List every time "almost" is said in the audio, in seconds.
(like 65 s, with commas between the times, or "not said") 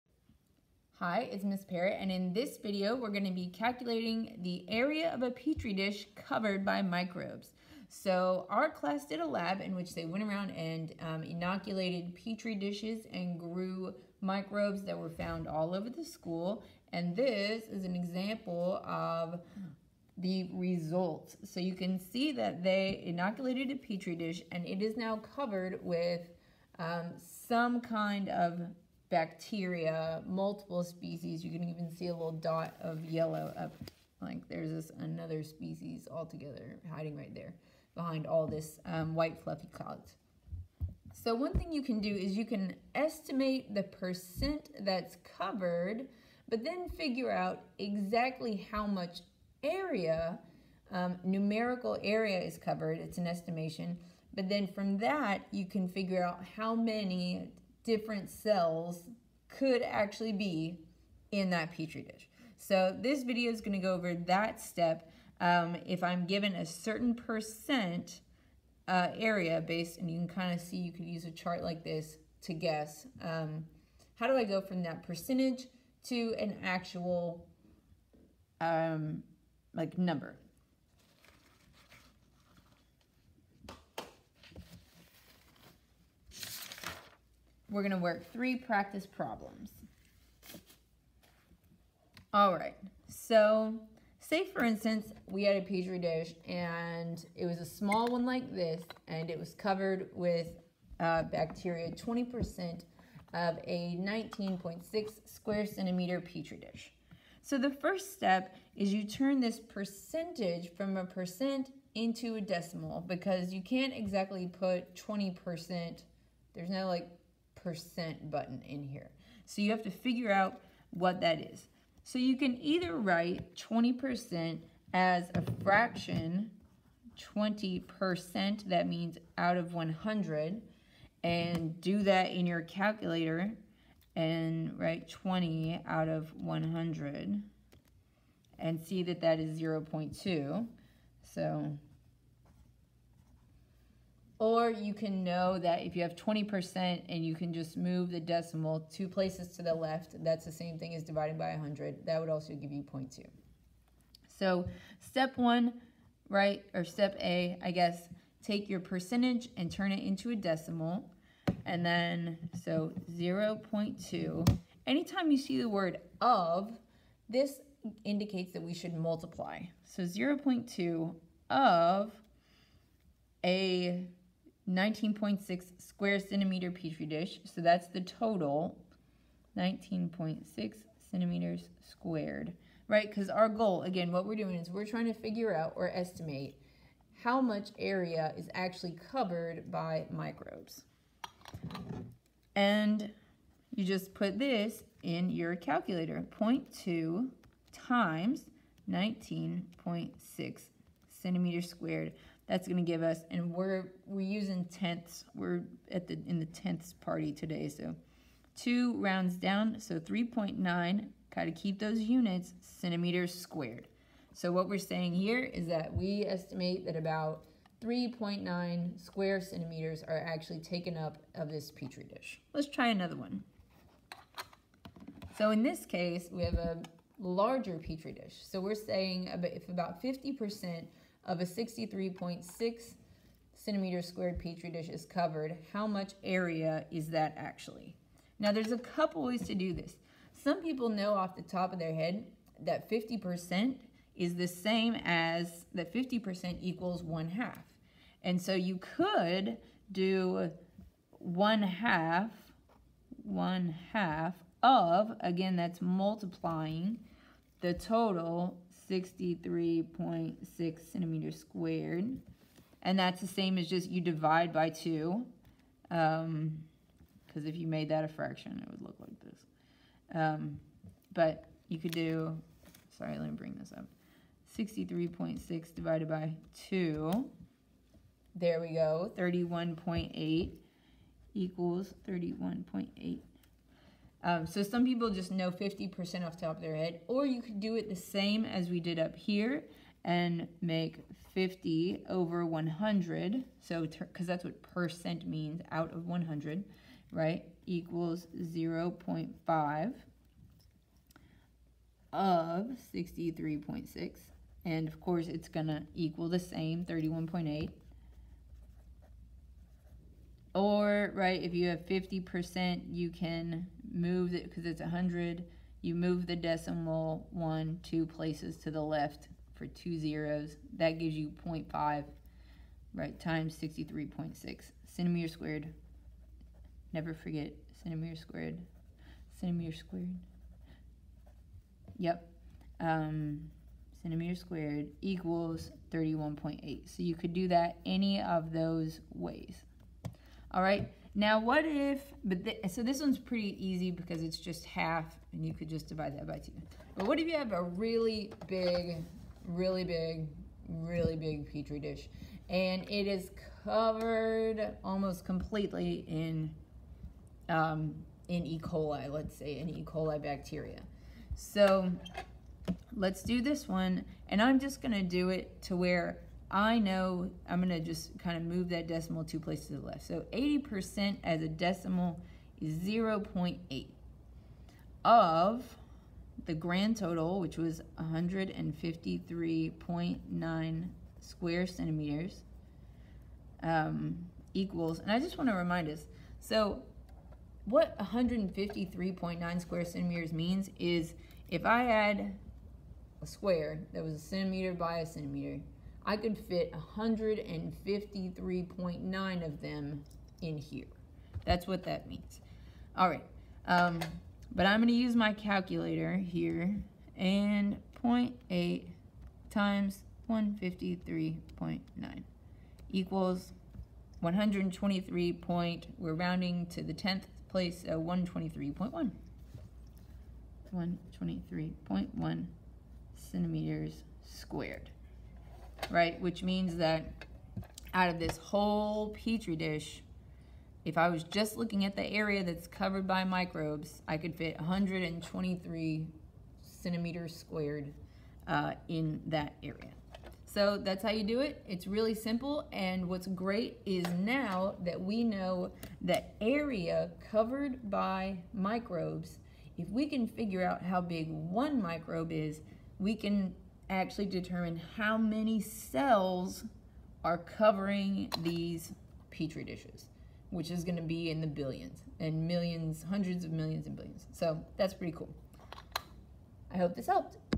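354 s.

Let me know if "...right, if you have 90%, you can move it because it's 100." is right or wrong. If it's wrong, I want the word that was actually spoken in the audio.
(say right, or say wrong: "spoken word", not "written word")
wrong: "50", not "90".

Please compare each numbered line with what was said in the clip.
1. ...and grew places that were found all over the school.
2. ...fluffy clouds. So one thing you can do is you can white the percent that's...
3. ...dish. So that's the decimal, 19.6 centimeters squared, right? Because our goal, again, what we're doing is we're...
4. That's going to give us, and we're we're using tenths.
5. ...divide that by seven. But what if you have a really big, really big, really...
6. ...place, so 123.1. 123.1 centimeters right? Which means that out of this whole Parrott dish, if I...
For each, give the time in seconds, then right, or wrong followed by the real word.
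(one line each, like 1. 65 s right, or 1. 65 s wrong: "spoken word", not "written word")
1. 13 s wrong: "microbes", not "places"
2. 39 s wrong: "estimate", not "white"
3. 177 s wrong: "total", not "decimal"
4. 202 s right
5. 345 s wrong: "two", not "seven"
6. 417 s wrong: "Petri", not "Parrott".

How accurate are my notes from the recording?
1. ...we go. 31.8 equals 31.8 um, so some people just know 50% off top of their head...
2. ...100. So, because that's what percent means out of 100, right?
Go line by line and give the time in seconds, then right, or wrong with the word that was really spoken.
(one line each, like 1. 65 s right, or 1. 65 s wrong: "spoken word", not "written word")
1. 278 s right
2. 292 s right.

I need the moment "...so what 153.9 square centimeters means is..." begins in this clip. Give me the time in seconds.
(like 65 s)
386 s.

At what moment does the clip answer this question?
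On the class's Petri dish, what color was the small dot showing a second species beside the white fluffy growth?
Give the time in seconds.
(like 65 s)
33 s.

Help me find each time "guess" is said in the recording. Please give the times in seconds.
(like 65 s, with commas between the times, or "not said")
72 s, 157 s.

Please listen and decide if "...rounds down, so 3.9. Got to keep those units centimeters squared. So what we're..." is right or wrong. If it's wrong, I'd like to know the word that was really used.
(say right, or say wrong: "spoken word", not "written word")
right.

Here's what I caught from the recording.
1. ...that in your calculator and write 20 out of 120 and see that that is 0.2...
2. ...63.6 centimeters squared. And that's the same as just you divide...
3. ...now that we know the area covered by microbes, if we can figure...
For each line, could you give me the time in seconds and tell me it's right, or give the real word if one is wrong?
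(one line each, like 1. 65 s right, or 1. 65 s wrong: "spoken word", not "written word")
1. 132 s wrong: "100", not "120"
2. 258 s right
3. 444 s right.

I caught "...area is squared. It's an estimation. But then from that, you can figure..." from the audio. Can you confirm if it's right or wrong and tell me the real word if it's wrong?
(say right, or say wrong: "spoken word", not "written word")
wrong: "covered", not "squared".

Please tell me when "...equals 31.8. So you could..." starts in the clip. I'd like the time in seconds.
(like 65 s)
335 s.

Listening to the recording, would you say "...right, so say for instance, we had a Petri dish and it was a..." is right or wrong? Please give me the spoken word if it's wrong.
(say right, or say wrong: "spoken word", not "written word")
right.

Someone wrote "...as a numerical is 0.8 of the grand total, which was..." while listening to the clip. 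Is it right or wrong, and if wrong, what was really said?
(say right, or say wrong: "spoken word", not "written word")
wrong: "decimal", not "numerical".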